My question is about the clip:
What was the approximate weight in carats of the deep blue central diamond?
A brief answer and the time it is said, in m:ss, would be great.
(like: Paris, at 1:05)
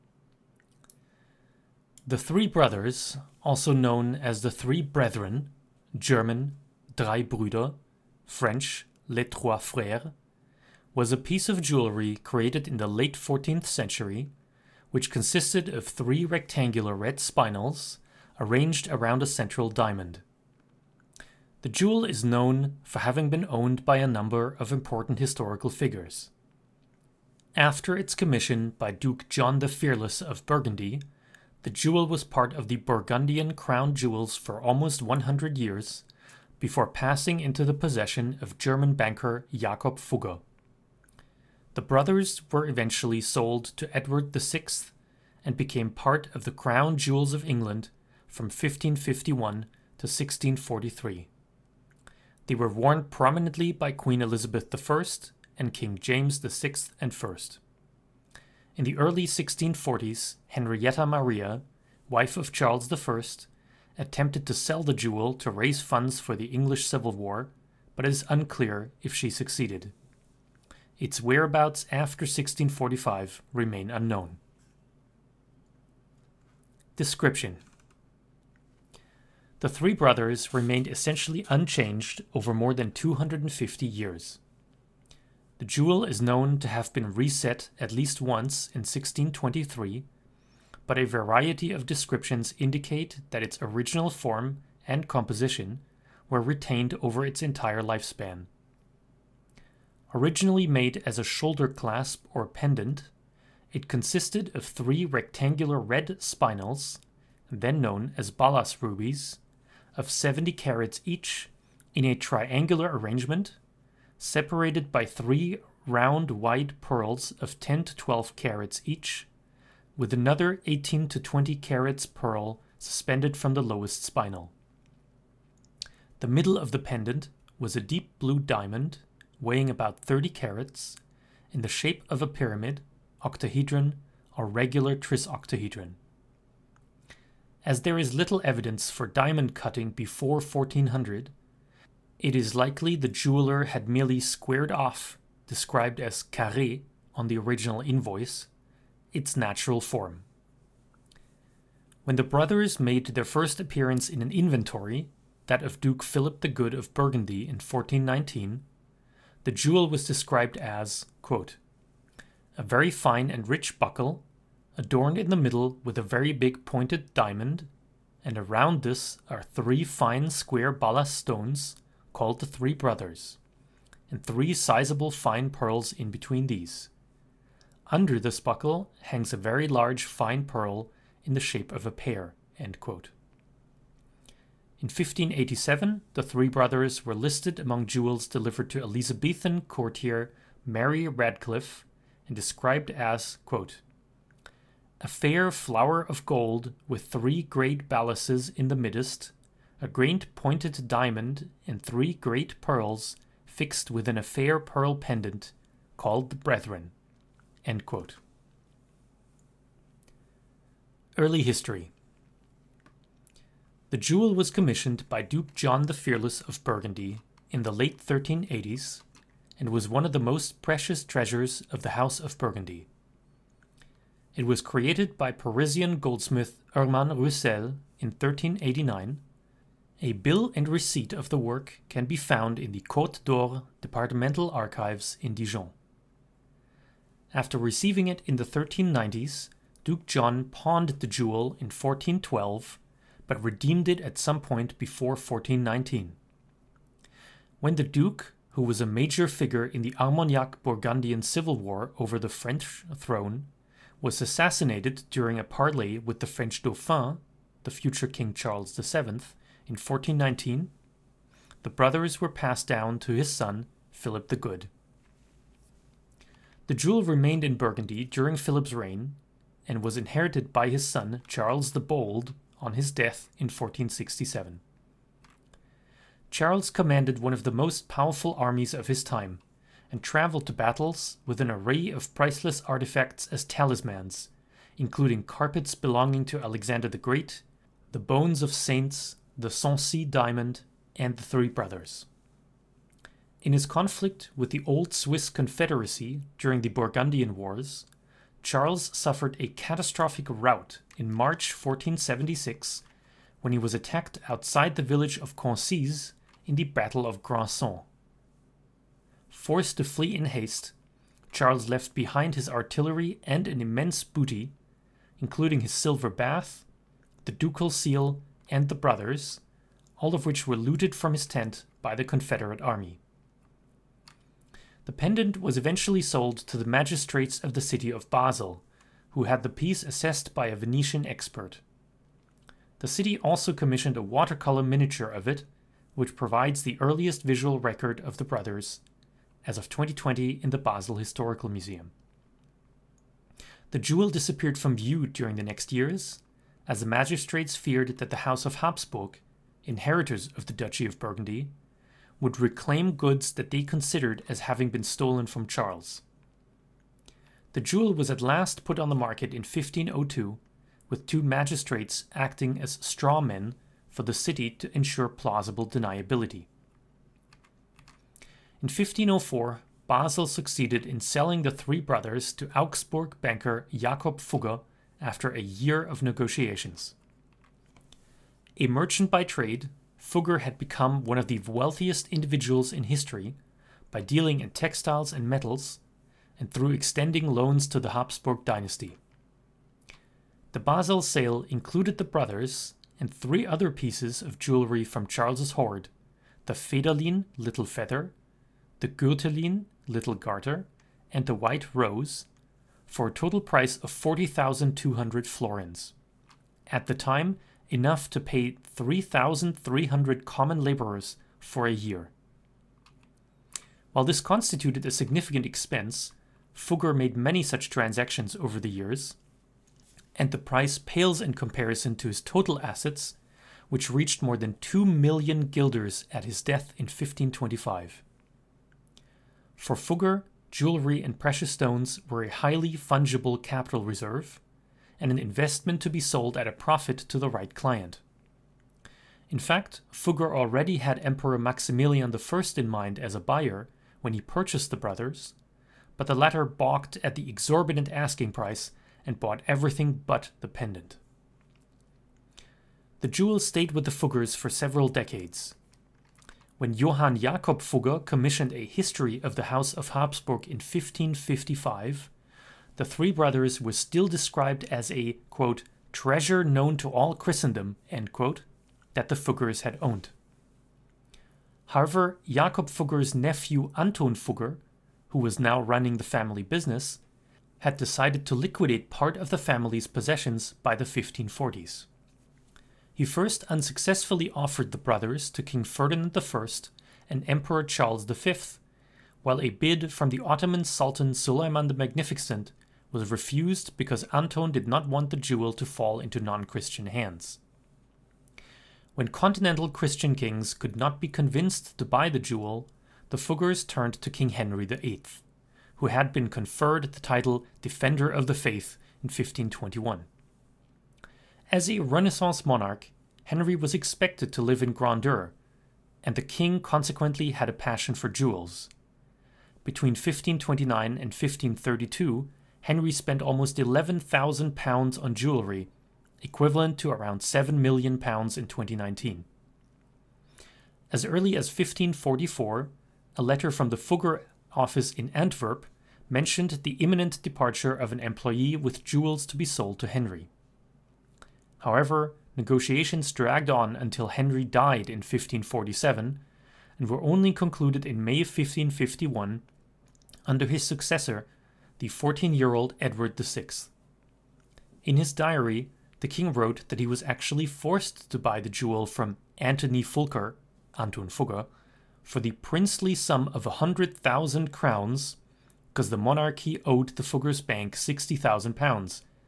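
30 carats, at 2:09.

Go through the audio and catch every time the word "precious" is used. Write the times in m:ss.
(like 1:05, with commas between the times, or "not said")
3:40, 7:11.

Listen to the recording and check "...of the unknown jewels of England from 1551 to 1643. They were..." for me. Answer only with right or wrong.
wrong.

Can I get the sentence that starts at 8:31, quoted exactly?
As a Renaissance monarch, Henry was expected to live in grandeur, and the king consequently had a passion for jewels.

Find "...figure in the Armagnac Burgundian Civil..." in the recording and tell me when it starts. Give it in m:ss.
4:09.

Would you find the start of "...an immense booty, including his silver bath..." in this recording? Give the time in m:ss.
5:13.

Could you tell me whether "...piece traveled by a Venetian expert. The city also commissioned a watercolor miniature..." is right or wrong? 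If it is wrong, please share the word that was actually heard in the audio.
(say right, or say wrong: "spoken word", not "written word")
wrong: "assessed", not "traveled".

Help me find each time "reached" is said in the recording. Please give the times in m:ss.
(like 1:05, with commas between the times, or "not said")
7:03.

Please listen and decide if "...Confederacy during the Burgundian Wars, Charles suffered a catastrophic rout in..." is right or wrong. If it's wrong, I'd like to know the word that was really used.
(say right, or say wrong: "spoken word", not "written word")
right.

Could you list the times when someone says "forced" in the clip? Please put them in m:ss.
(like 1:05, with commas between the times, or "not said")
5:09, 9:17.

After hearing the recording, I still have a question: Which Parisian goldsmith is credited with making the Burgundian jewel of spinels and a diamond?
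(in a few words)
Hermann Roussel.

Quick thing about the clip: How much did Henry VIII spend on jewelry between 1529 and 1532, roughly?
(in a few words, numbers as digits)
£11,000.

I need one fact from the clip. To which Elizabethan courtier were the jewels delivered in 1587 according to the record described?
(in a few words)
Mary Radcliffe.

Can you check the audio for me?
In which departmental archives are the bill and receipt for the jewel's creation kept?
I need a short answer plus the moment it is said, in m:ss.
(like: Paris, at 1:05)
Côte d'Or, at 3:52.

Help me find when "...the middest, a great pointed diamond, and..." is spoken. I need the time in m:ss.
3:18.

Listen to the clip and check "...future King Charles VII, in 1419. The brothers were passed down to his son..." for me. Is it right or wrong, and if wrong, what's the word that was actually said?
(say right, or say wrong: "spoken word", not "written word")
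right.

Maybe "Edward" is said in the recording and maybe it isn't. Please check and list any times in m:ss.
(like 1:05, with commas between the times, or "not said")
0:43, 9:12.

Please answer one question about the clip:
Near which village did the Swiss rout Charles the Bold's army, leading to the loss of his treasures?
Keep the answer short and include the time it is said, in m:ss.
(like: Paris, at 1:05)
Concise, at 5:05.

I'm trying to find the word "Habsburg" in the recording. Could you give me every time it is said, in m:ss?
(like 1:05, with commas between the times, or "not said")
5:48, 6:27, 7:39.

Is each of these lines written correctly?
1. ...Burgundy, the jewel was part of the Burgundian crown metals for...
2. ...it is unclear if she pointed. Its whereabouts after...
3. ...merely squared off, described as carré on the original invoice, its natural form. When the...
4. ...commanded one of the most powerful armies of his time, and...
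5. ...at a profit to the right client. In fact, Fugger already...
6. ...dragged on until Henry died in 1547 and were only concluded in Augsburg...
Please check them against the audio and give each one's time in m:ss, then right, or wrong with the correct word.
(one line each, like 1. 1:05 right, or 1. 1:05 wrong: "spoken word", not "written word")
1. 0:30 wrong: "jewels", not "metals"
2. 1:08 wrong: "succeeded", not "pointed"
3. 2:23 right
4. 4:36 right
5. 7:16 right
6. 9:03 wrong: "May", not "Augsburg".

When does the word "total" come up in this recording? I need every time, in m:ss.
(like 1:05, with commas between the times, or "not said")
6:43, 7:02.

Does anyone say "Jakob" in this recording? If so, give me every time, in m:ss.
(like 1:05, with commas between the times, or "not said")
0:39, 6:13, 7:37, 7:52.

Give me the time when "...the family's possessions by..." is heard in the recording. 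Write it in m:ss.
7:59.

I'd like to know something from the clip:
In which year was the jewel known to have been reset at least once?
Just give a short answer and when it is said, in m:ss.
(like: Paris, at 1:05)
1623, at 1:28.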